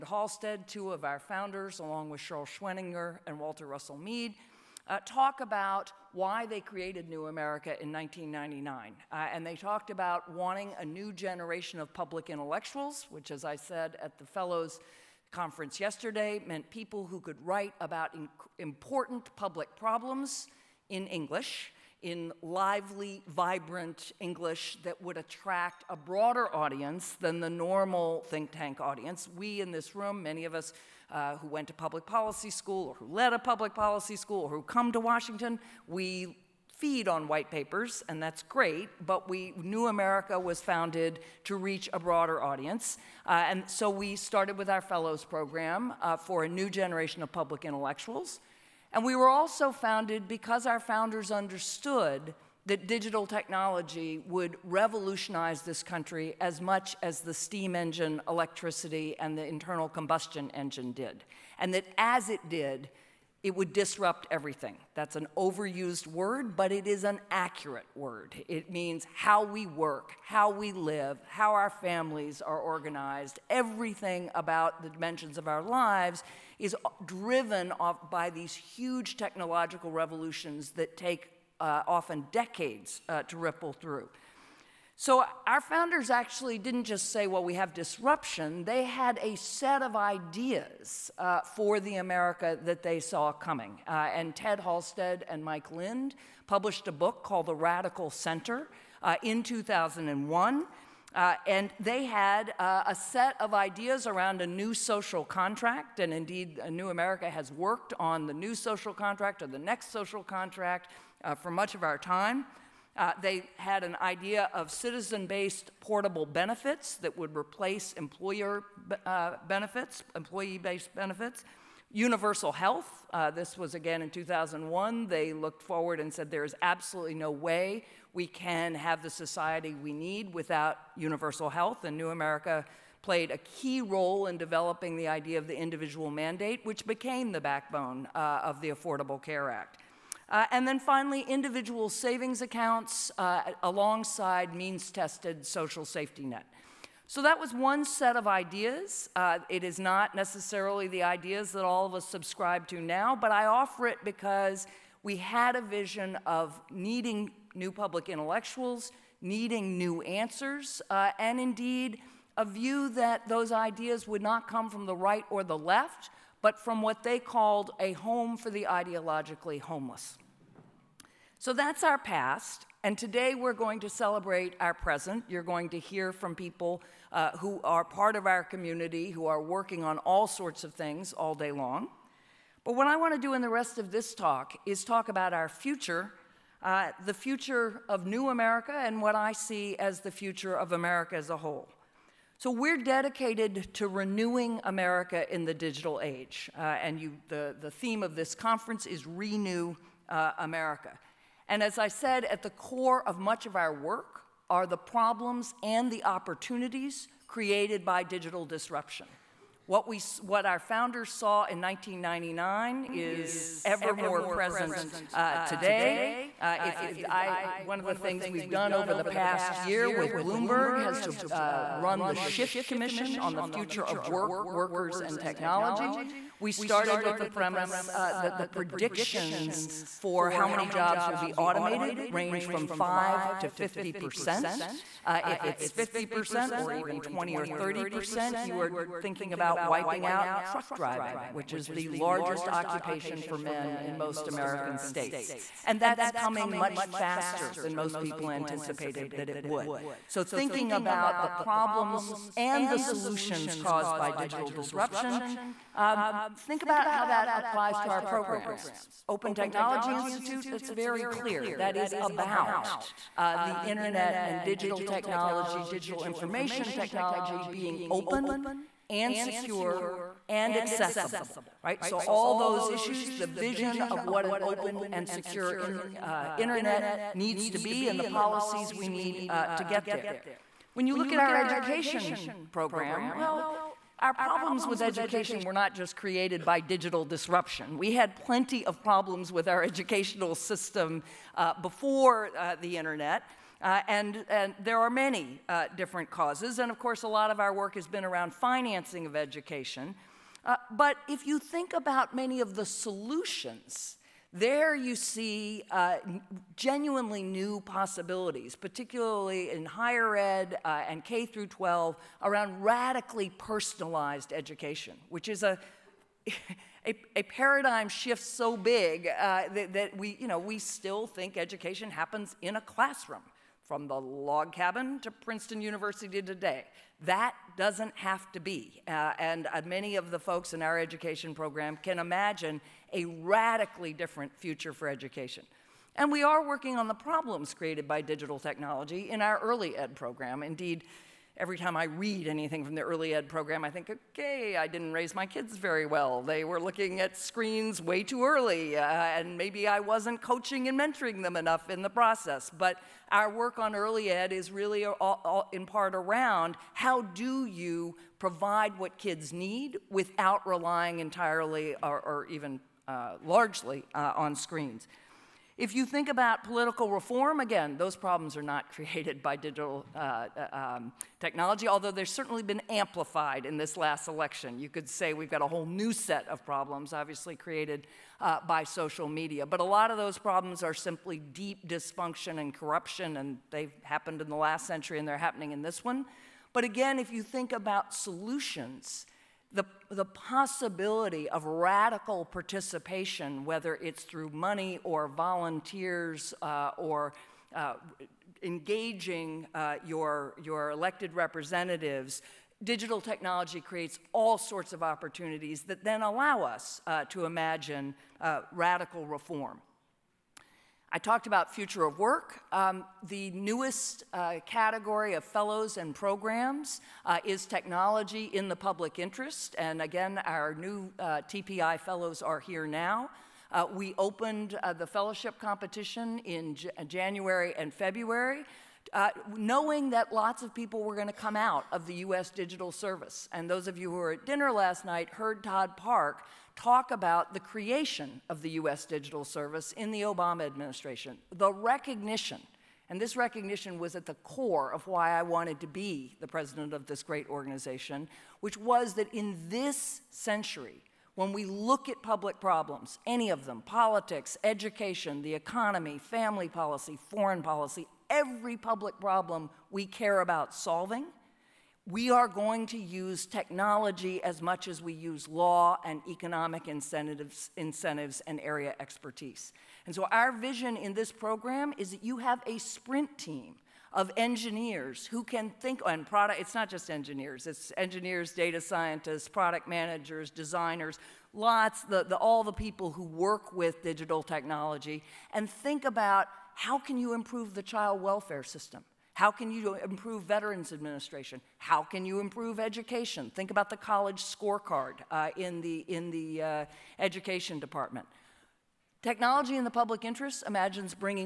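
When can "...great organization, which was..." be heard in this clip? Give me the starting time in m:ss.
7:27.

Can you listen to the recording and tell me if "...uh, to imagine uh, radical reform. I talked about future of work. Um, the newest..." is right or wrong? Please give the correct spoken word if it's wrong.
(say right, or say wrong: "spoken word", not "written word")
right.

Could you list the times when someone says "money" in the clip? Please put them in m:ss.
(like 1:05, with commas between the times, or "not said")
6:34.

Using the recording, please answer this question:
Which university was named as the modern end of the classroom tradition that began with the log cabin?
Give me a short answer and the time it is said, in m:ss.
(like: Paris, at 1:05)
Princeton University, at 5:25.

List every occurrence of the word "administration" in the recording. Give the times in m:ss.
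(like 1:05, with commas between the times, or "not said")
7:20, 8:10.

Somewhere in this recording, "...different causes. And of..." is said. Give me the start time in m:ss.
4:55.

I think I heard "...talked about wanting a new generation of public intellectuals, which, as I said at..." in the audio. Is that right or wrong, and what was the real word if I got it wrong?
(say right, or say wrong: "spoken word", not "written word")
right.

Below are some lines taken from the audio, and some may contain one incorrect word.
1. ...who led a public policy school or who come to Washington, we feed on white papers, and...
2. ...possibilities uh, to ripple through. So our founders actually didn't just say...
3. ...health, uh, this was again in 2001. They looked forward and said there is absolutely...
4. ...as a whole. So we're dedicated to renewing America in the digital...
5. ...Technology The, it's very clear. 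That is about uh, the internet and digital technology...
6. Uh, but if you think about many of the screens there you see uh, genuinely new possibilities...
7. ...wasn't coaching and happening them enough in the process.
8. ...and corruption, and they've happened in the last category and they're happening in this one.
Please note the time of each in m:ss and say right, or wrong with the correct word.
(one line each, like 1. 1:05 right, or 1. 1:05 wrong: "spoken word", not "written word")
1. 0:32 right
2. 1:22 wrong: "decades", not "possibilities"
3. 2:02 right
4. 3:11 right
5. 4:19 wrong: "Institute", not "The"
6. 5:00 wrong: "solutions", not "screens"
7. 5:49 wrong: "mentoring", not "happening"
8. 6:22 wrong: "century", not "category".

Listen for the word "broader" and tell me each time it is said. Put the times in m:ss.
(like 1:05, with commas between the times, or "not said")
0:25, 0:41.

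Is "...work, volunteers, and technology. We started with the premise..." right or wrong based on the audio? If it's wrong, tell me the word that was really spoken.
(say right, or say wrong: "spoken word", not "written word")
wrong: "workers", not "volunteers".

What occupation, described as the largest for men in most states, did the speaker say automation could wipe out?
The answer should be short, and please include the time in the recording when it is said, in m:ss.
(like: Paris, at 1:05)
truck driving, at 4:00.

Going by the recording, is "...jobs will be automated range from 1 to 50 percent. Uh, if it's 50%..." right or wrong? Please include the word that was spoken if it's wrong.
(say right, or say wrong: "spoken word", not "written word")
wrong: "5", not "1".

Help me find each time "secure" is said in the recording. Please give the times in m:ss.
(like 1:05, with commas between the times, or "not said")
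4:29, 4:35.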